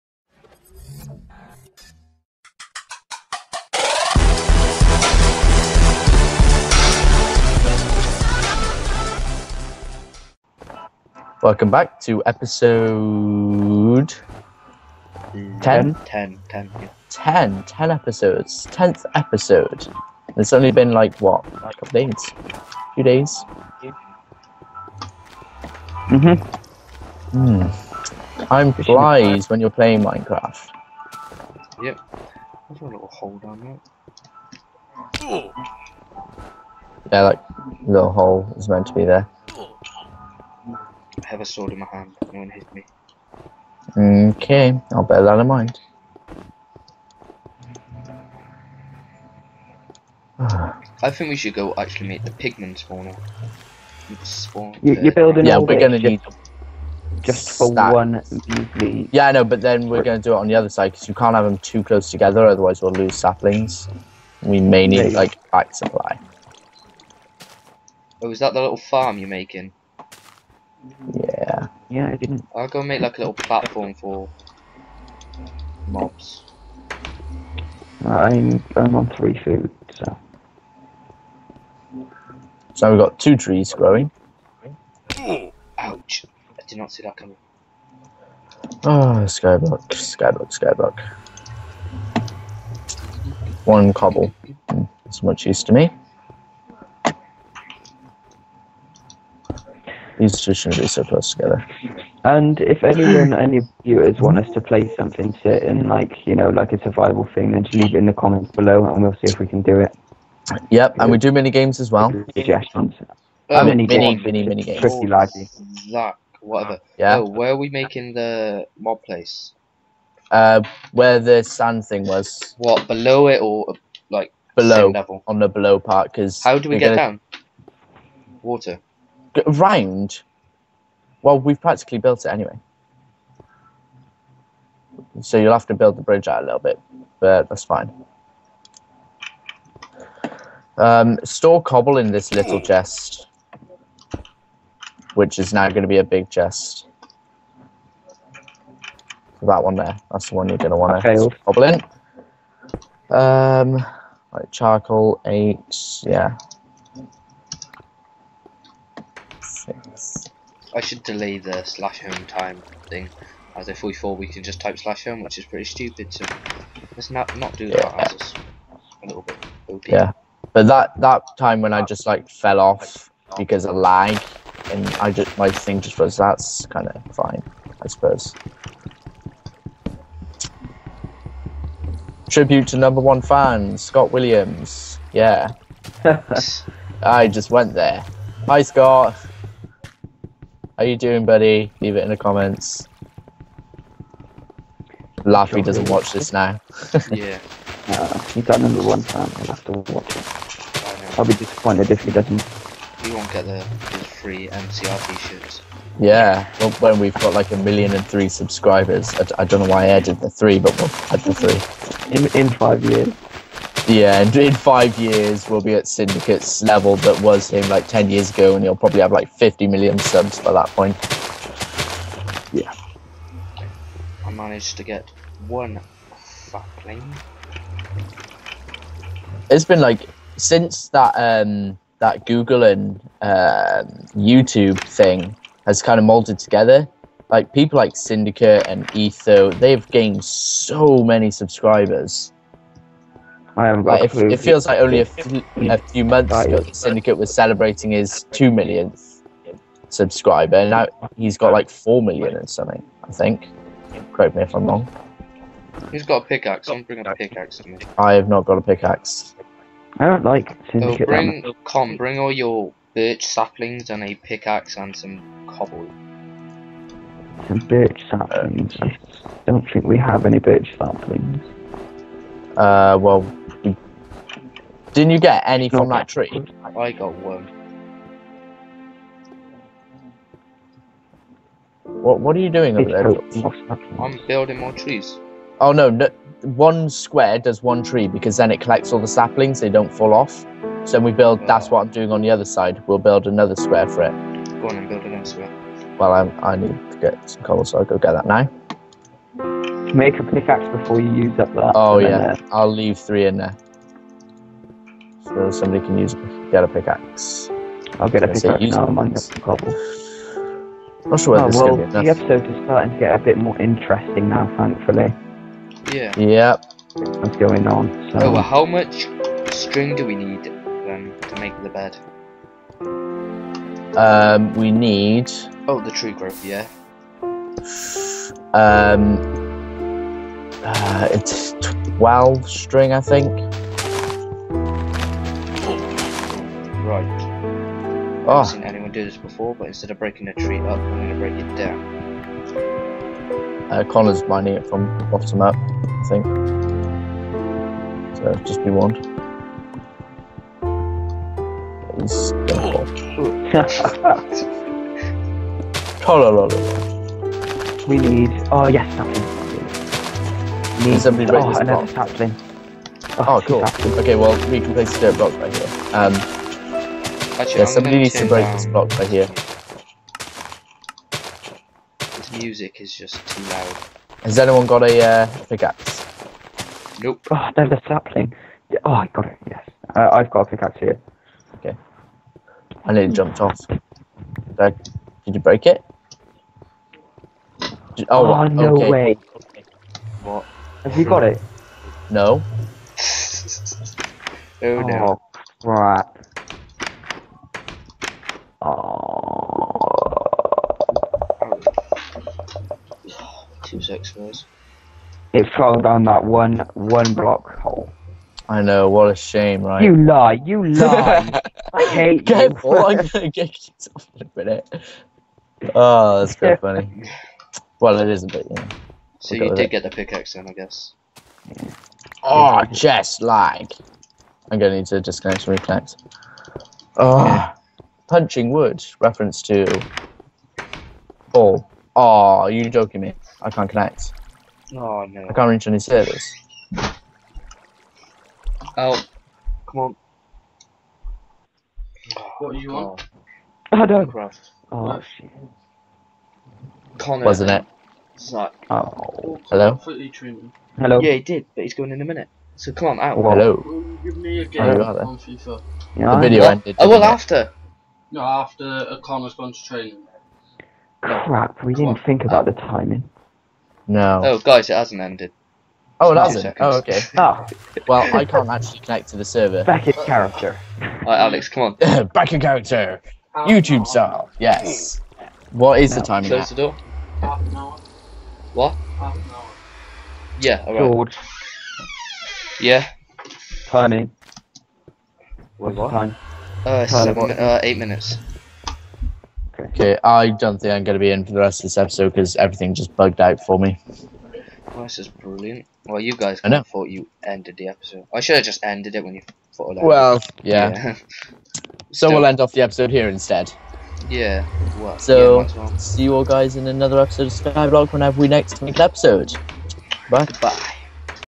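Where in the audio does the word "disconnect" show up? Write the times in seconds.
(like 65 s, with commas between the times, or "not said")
425 s.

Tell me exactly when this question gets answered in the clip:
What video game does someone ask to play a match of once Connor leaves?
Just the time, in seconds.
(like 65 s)
455 s.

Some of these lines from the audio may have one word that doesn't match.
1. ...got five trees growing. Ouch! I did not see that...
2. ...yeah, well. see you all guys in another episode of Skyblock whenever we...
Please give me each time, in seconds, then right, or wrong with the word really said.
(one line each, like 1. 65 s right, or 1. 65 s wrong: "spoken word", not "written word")
1. 82 s wrong: "two", not "five"
2. 505 s right.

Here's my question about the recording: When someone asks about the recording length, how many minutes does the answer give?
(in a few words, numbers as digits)
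8.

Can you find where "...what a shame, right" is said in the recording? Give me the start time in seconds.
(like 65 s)
408 s.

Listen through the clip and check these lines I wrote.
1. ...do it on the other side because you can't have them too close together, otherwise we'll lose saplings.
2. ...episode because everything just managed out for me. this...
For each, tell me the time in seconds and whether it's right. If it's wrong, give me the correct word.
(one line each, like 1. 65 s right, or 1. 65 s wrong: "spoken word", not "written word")
1. 60 s right
2. 491 s wrong: "bugged", not "managed".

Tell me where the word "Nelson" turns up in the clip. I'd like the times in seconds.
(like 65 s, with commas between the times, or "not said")
not said.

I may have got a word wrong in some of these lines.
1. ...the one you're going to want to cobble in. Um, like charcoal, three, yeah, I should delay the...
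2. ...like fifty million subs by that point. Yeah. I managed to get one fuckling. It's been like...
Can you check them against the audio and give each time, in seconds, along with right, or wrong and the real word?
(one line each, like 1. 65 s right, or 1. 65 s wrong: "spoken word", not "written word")
1. 150 s wrong: "eight", not "three"
2. 219 s right.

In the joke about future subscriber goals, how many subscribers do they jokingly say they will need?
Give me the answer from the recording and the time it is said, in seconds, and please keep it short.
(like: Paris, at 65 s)
a million and three, at 207 s.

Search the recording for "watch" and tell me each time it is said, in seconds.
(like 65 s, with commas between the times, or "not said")
195 s, 199 s.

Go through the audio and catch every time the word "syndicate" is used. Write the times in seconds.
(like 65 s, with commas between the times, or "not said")
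215 s, 237 s, 246 s, 260 s.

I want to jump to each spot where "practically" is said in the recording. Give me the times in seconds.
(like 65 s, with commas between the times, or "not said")
131 s.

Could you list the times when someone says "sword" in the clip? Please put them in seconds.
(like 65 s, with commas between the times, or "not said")
41 s.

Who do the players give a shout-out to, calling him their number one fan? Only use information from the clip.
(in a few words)
Scott Williams.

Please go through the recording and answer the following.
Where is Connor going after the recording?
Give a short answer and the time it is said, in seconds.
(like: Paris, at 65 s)
training, at 459 s.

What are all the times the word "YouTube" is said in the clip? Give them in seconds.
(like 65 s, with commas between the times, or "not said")
234 s, 473 s.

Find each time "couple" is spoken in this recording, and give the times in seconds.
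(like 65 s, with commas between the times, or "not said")
21 s.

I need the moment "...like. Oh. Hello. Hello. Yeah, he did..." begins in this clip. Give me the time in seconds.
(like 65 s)
448 s.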